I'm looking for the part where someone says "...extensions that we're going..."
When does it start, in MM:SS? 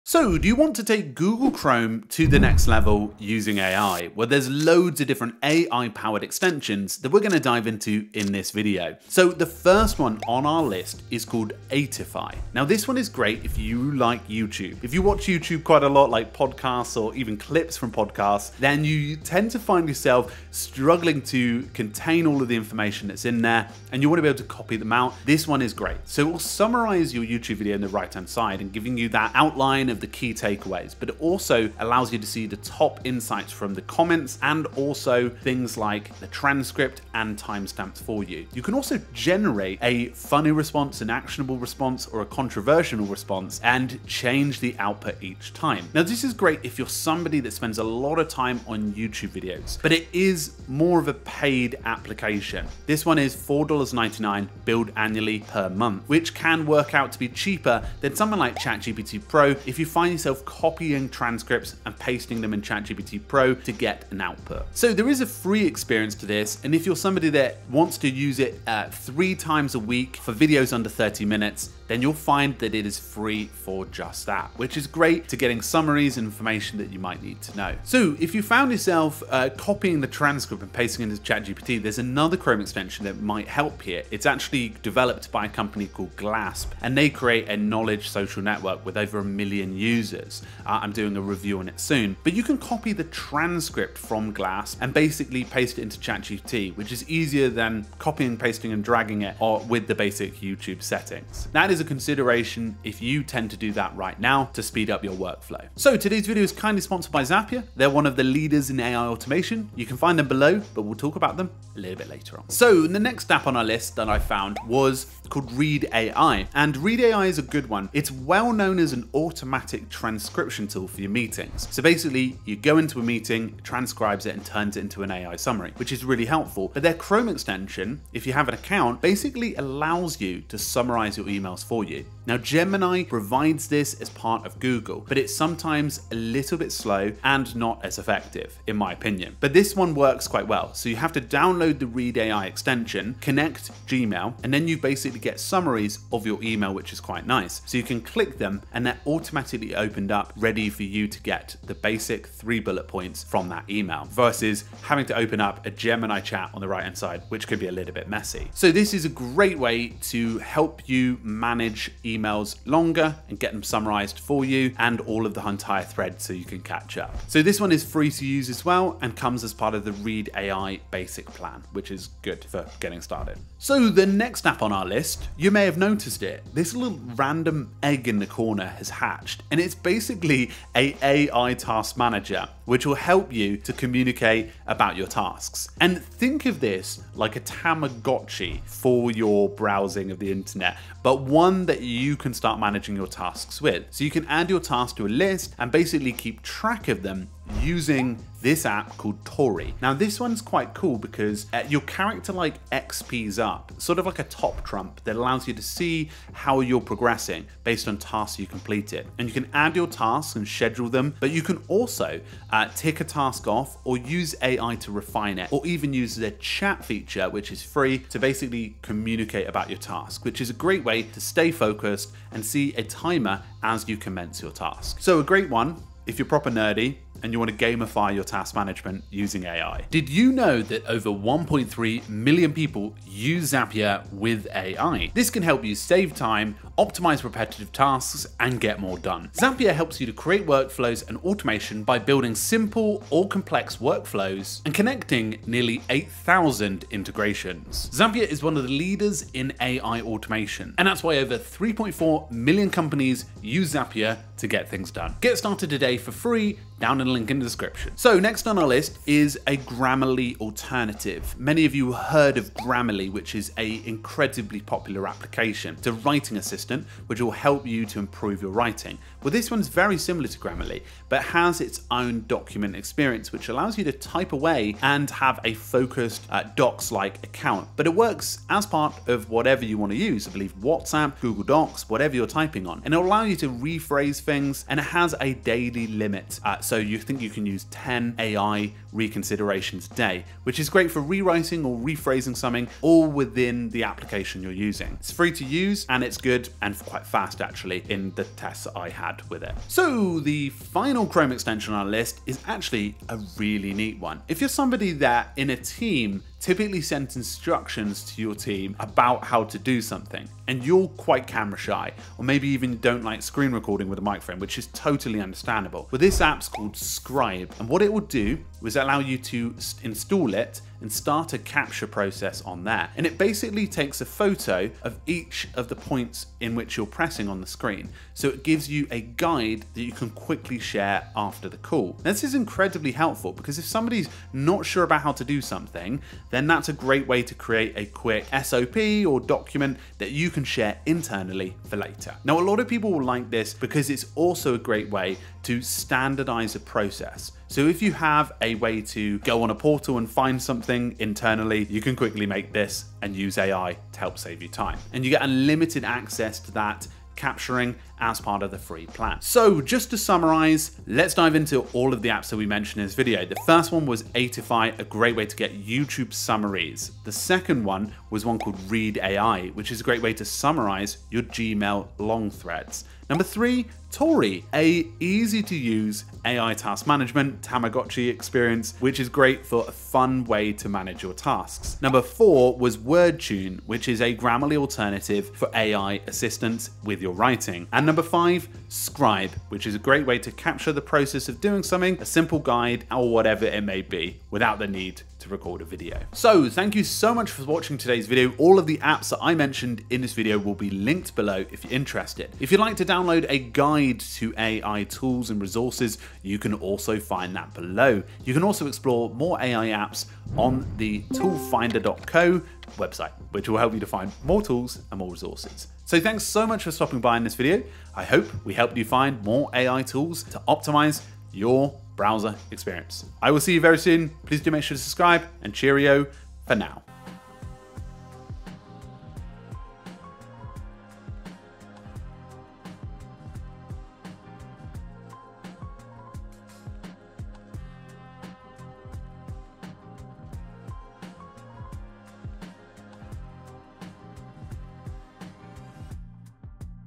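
00:06.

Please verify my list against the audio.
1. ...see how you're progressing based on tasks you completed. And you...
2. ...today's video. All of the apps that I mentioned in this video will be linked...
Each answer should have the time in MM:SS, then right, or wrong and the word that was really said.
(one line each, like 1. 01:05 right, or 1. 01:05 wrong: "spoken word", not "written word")
1. 03:25 right
2. 06:37 right.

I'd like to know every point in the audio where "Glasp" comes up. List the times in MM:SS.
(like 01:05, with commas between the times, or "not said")
01:26, 01:34.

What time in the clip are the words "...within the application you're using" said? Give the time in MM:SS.
04:53.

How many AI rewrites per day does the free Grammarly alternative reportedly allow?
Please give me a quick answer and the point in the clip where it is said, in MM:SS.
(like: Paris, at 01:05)
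10, at 04:47.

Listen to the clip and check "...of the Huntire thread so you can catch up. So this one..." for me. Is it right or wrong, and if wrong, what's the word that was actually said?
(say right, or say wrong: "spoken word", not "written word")
right.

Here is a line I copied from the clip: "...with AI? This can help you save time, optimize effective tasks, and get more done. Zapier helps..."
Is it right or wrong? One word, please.
wrong.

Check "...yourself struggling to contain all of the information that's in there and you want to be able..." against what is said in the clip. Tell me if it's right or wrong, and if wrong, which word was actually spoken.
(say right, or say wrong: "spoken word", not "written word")
right.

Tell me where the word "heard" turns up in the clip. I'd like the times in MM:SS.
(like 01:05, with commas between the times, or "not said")
04:21.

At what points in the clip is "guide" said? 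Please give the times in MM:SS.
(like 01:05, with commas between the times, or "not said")
05:29, 06:32, 06:43.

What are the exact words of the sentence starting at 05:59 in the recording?
So just to summarize, let's dive into all of the apps that we mentioned in this video.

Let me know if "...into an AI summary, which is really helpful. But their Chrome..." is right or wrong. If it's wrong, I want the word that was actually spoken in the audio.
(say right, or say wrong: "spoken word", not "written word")
right.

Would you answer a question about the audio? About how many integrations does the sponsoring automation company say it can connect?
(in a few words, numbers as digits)
nearly 8,000.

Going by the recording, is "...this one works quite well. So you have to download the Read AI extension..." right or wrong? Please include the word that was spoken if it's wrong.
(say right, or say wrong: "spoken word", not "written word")
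right.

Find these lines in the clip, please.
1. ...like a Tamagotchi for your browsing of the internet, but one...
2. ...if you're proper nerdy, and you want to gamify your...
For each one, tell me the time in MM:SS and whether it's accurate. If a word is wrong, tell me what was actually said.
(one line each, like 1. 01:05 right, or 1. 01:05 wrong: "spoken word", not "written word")
1. 03:07 right
2. 03:46 right.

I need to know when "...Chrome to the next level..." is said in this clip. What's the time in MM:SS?
00:01.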